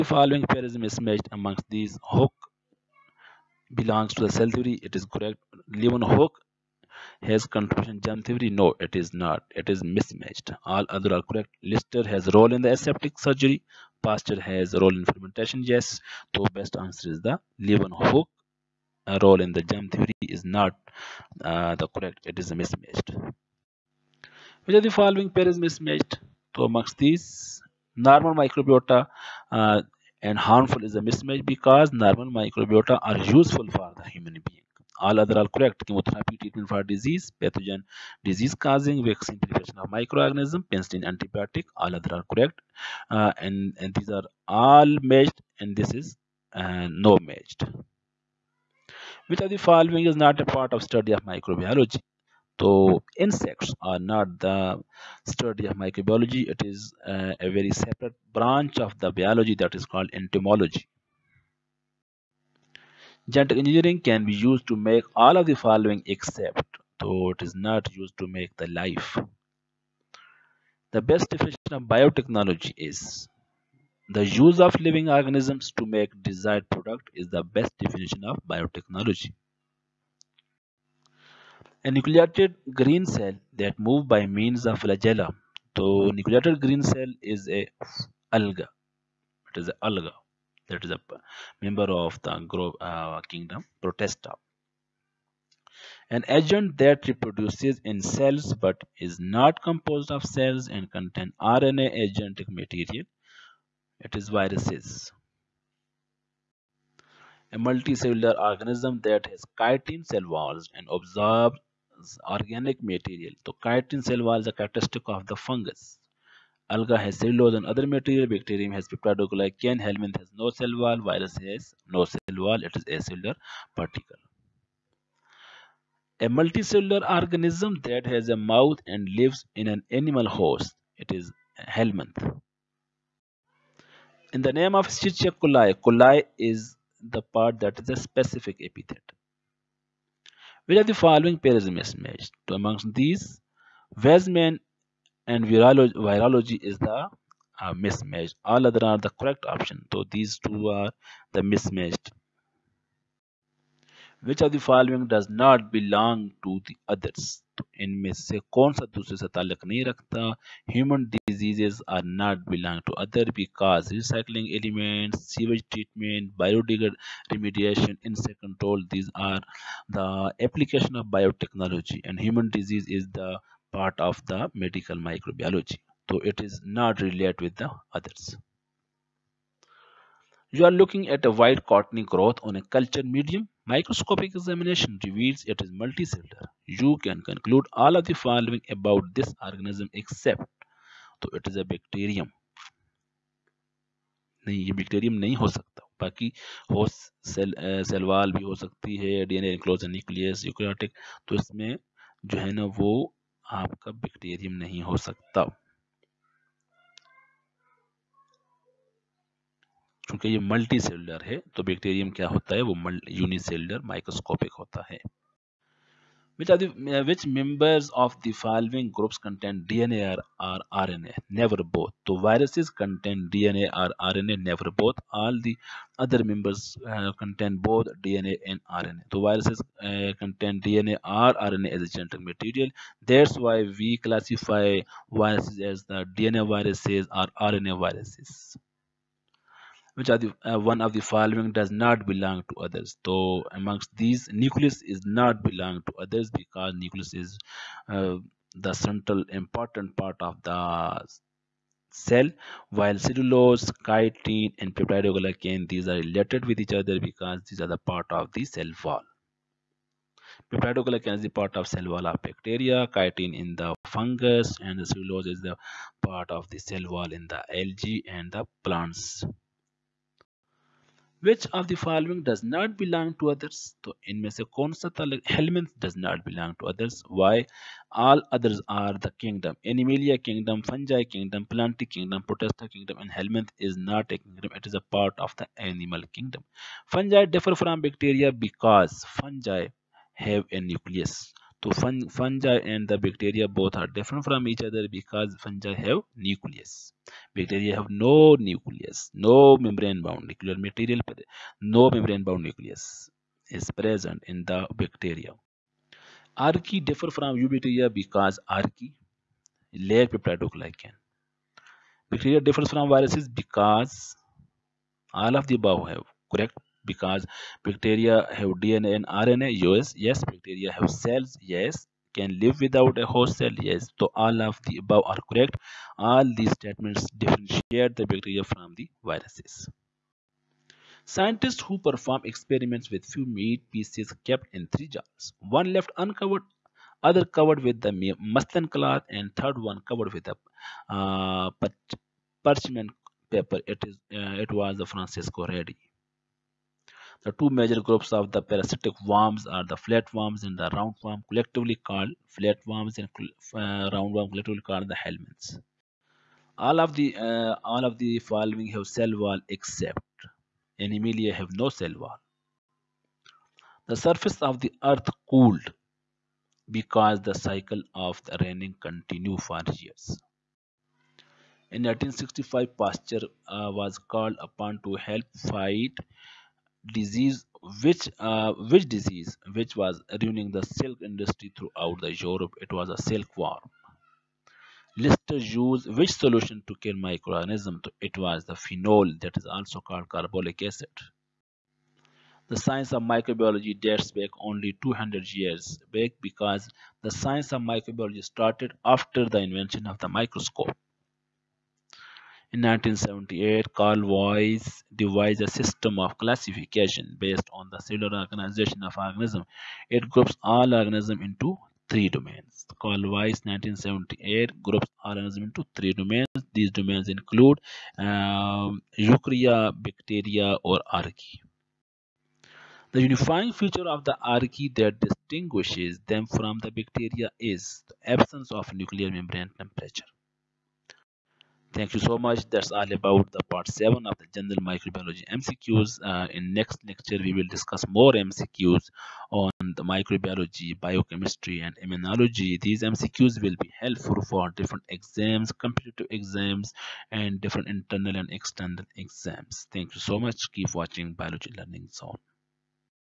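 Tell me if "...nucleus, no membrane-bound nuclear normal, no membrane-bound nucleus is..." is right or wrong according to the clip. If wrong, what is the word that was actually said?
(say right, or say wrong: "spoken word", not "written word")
wrong: "material", not "normal".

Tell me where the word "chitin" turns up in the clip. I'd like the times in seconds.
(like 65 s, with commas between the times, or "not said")
109 s, 113 s, 253 s, 262 s.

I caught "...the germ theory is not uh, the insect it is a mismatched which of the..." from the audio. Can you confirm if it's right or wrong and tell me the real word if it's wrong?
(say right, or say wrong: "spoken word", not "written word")
wrong: "correct", not "insect".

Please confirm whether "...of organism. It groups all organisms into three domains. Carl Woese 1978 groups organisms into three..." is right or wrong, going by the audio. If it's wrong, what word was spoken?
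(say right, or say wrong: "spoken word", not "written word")
right.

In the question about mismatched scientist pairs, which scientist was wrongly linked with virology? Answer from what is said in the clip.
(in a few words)
Weizmann.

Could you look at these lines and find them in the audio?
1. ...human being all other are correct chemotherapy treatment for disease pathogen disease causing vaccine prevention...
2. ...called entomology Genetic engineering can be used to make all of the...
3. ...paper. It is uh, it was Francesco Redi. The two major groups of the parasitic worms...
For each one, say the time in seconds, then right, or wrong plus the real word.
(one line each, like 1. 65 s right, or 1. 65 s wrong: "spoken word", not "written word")
1. 34 s right
2. 59 s right
3. 343 s right.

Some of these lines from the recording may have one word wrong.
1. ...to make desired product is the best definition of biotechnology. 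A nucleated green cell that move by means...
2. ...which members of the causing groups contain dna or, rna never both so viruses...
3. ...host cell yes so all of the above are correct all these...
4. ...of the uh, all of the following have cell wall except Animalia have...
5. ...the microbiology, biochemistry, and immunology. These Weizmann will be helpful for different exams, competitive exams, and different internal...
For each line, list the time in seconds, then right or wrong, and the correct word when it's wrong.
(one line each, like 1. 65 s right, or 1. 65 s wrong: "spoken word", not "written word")
1. 75 s right
2. 217 s wrong: "following", not "causing"
3. 323 s right
4. 356 s right
5. 439 s wrong: "MCQs", not "Weizmann".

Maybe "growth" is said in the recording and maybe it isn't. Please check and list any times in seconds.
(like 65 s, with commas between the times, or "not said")
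182 s.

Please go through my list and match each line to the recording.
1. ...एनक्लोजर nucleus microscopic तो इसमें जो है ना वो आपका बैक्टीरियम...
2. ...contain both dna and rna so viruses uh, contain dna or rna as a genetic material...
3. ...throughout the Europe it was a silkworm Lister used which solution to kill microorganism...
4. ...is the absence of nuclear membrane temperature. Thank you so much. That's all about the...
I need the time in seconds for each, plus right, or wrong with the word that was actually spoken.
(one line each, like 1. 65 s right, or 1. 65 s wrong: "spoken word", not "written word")
1. 199 s wrong: "eukaryotic", not "microscopic"
2. 227 s right
3. 381 s right
4. 427 s right.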